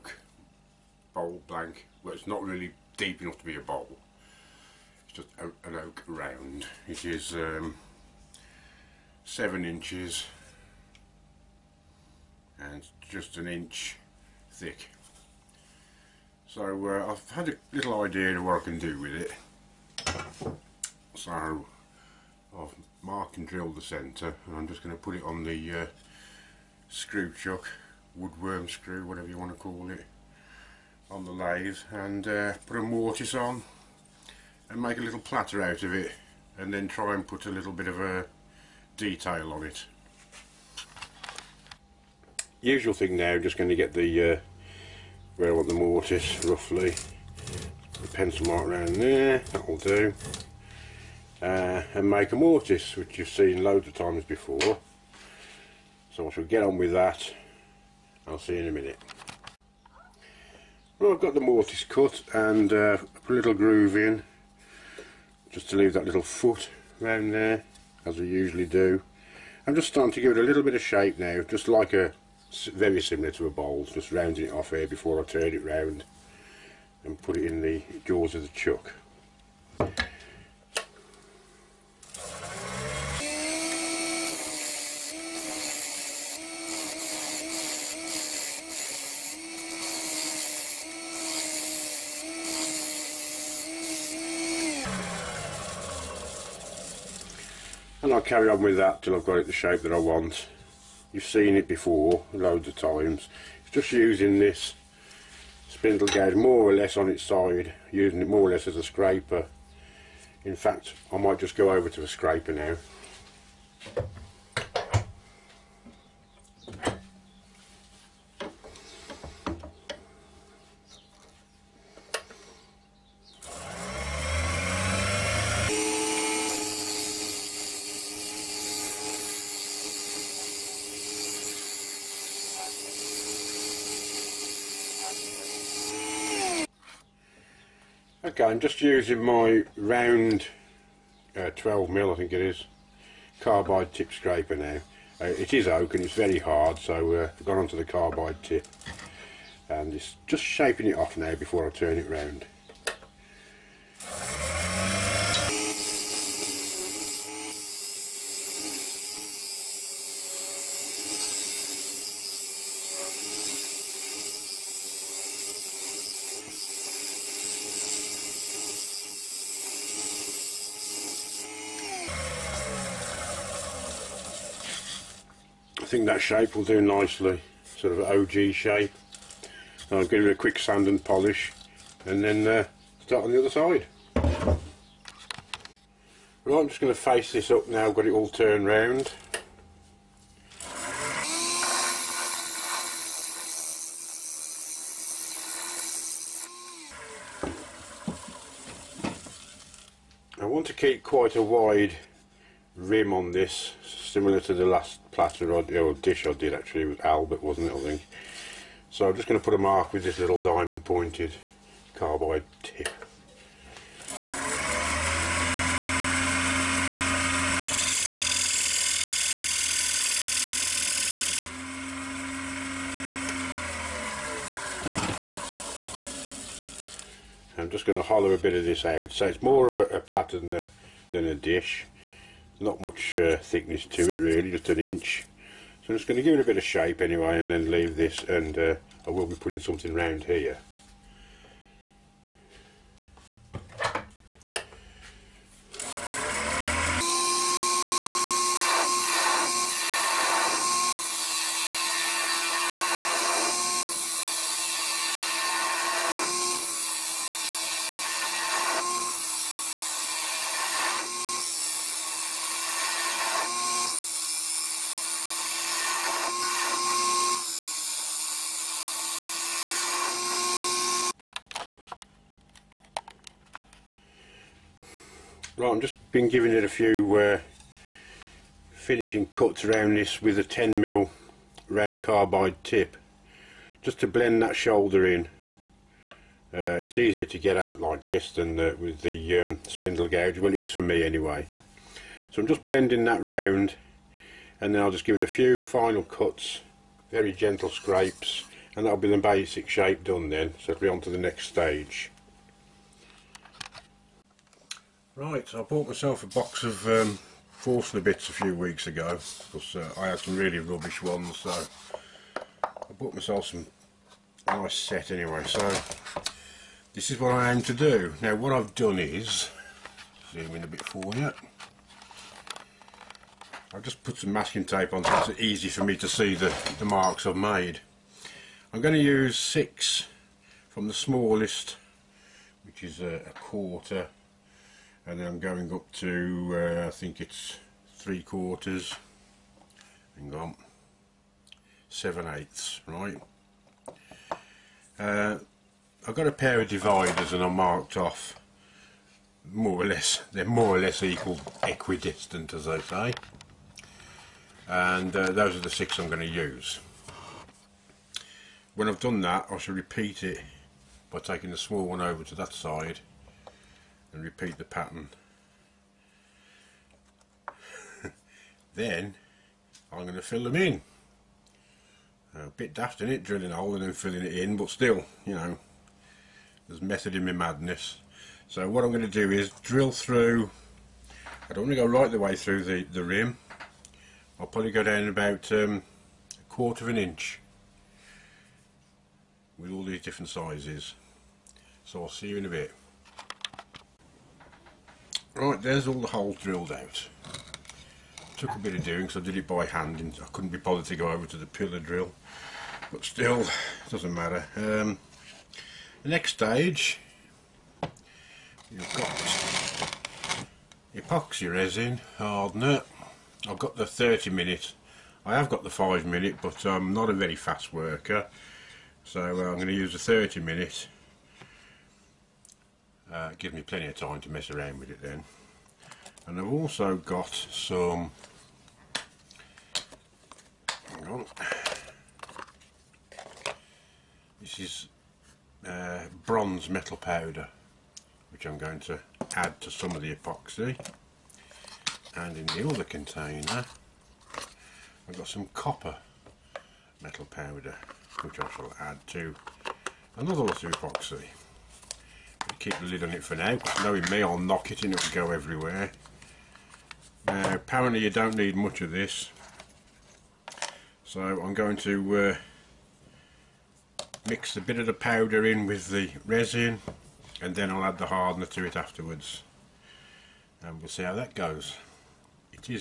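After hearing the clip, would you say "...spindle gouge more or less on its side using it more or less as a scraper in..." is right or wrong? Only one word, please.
right.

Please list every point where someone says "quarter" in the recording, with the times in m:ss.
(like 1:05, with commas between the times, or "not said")
5:33, 5:38, 6:26.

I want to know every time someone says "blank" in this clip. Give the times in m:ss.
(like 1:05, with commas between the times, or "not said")
0:01.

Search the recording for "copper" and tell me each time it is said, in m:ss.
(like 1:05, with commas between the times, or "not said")
7:25.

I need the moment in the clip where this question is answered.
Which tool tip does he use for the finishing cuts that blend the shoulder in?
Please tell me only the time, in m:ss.
4:40.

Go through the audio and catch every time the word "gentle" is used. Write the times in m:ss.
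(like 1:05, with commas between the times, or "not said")
4:57.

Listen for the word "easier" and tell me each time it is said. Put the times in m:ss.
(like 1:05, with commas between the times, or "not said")
4:46.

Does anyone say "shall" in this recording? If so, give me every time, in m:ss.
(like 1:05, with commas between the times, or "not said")
0:56, 5:59, 7:28.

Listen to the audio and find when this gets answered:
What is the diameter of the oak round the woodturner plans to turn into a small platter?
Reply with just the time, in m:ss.
0:09.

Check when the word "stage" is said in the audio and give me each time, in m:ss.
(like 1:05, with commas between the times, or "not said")
5:01, 6:46.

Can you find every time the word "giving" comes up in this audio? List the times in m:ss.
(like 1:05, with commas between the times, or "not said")
4:36.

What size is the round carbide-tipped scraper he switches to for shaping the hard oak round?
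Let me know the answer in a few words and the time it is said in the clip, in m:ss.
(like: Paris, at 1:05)
12 mil, at 2:21.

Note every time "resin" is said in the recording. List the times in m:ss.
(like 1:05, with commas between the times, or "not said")
6:51, 7:46.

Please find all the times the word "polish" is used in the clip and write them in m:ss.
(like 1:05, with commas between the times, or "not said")
3:01.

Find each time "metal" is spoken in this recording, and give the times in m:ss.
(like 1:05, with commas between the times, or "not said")
7:16, 7:27.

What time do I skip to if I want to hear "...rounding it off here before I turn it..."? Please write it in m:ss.
1:14.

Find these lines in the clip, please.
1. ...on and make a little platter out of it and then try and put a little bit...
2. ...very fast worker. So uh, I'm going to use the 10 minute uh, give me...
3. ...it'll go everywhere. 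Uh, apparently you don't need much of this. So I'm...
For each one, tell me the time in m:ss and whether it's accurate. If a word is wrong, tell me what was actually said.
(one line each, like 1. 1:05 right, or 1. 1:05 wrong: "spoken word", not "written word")
1. 0:33 right
2. 6:57 wrong: "30", not "10"
3. 7:34 right.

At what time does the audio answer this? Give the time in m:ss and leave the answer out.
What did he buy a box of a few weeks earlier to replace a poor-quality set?
5:07.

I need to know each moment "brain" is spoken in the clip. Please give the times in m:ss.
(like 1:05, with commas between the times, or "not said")
not said.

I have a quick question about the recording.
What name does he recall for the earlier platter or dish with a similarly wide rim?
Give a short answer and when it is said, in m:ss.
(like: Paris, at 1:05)
Albert, at 3:27.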